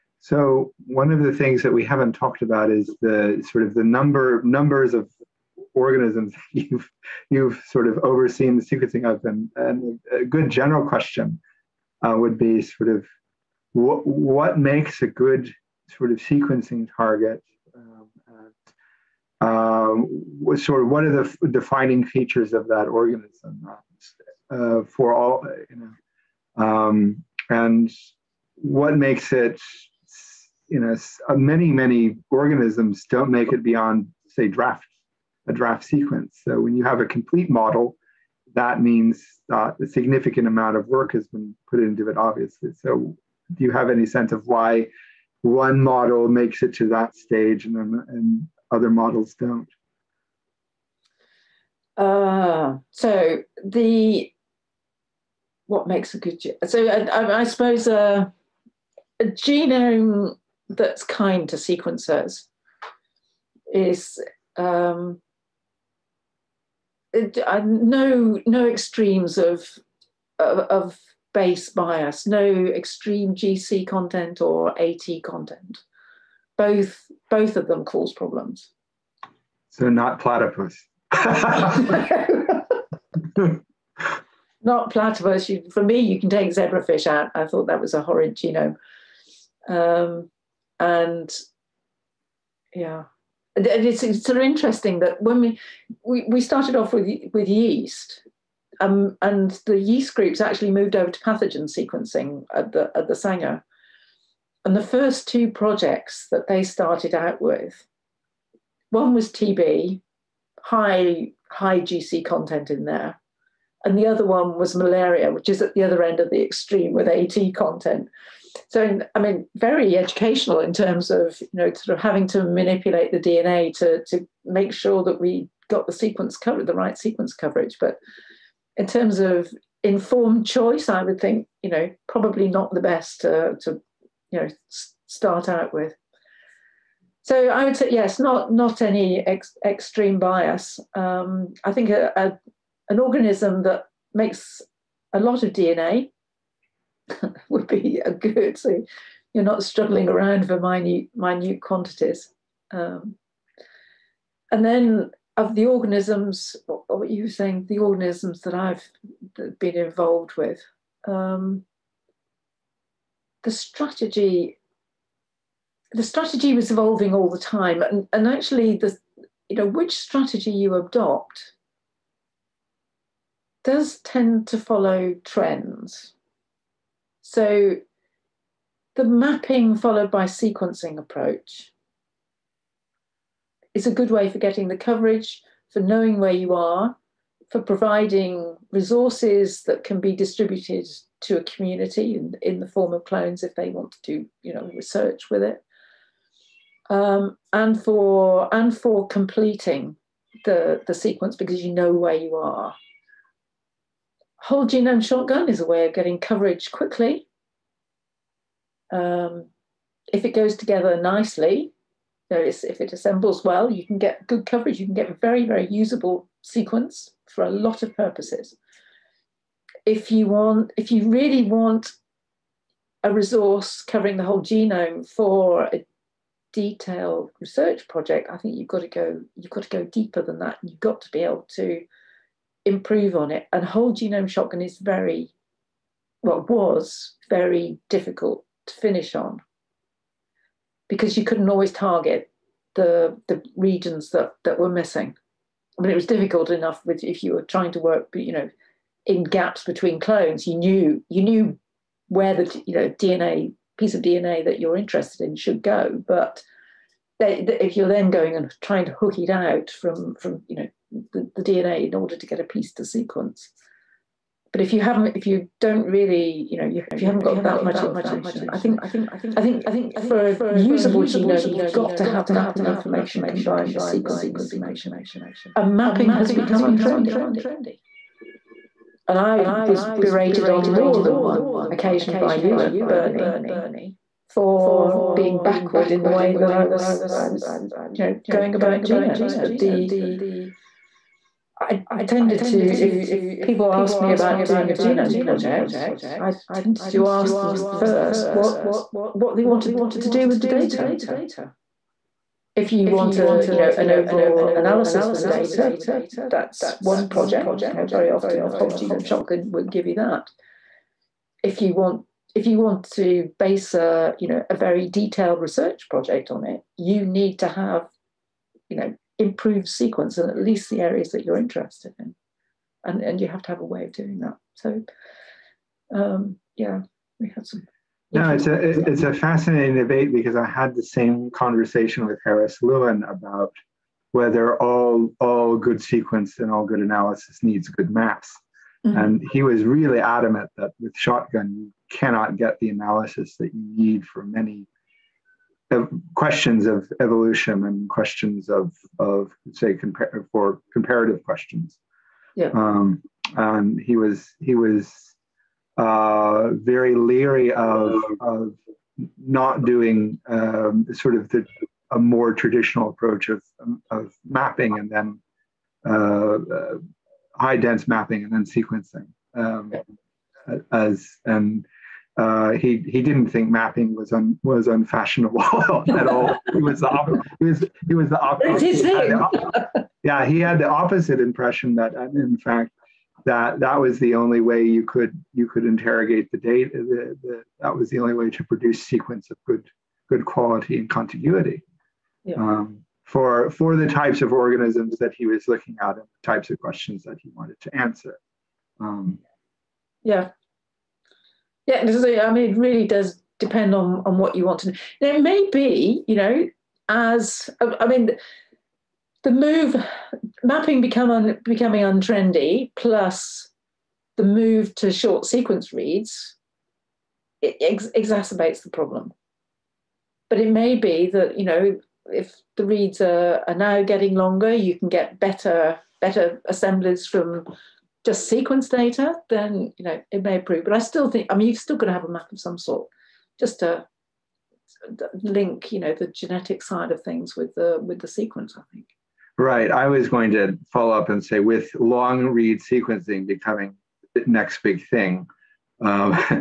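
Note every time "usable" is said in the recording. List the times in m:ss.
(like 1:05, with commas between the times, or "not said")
3:35, 4:30.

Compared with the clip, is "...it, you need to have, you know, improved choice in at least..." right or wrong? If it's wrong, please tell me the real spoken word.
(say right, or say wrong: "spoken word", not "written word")
wrong: "sequence", not "choice".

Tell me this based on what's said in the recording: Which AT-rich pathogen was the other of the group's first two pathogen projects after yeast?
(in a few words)
Malaria.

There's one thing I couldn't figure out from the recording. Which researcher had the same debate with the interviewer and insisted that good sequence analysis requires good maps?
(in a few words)
Harris Lewin.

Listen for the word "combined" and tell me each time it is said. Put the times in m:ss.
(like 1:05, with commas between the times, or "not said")
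4:33.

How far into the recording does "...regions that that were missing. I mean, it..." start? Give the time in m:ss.
4:03.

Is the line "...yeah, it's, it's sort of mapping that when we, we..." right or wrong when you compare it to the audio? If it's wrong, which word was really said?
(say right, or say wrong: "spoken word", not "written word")
wrong: "interesting", not "mapping".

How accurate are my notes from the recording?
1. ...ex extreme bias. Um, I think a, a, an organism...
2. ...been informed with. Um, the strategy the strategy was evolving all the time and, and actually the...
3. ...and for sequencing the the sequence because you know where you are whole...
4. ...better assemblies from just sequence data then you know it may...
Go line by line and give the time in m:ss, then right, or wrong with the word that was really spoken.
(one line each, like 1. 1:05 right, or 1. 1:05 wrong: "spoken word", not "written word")
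1. 2:19 right
2. 2:39 wrong: "involved", not "informed"
3. 3:18 wrong: "completing", not "sequencing"
4. 7:06 right.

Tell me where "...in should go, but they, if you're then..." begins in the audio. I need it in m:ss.
4:15.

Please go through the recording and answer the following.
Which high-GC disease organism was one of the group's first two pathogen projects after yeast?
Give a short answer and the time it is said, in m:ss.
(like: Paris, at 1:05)
TB, at 1:49.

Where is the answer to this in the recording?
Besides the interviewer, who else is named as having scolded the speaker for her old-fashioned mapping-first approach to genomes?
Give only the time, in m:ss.
4:42.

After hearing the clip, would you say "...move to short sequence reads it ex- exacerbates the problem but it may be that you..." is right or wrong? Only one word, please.
right.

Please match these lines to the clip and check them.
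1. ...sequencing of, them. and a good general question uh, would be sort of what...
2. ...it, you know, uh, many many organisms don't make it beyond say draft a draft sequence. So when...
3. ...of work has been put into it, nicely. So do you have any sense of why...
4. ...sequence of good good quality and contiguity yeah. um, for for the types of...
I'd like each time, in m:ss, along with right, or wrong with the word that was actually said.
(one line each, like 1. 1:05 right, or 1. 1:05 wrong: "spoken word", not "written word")
1. 0:08 right
2. 0:29 right
3. 0:40 wrong: "obviously", not "nicely"
4. 6:28 right.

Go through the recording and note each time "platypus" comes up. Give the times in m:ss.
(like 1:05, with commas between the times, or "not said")
1:20, 1:24.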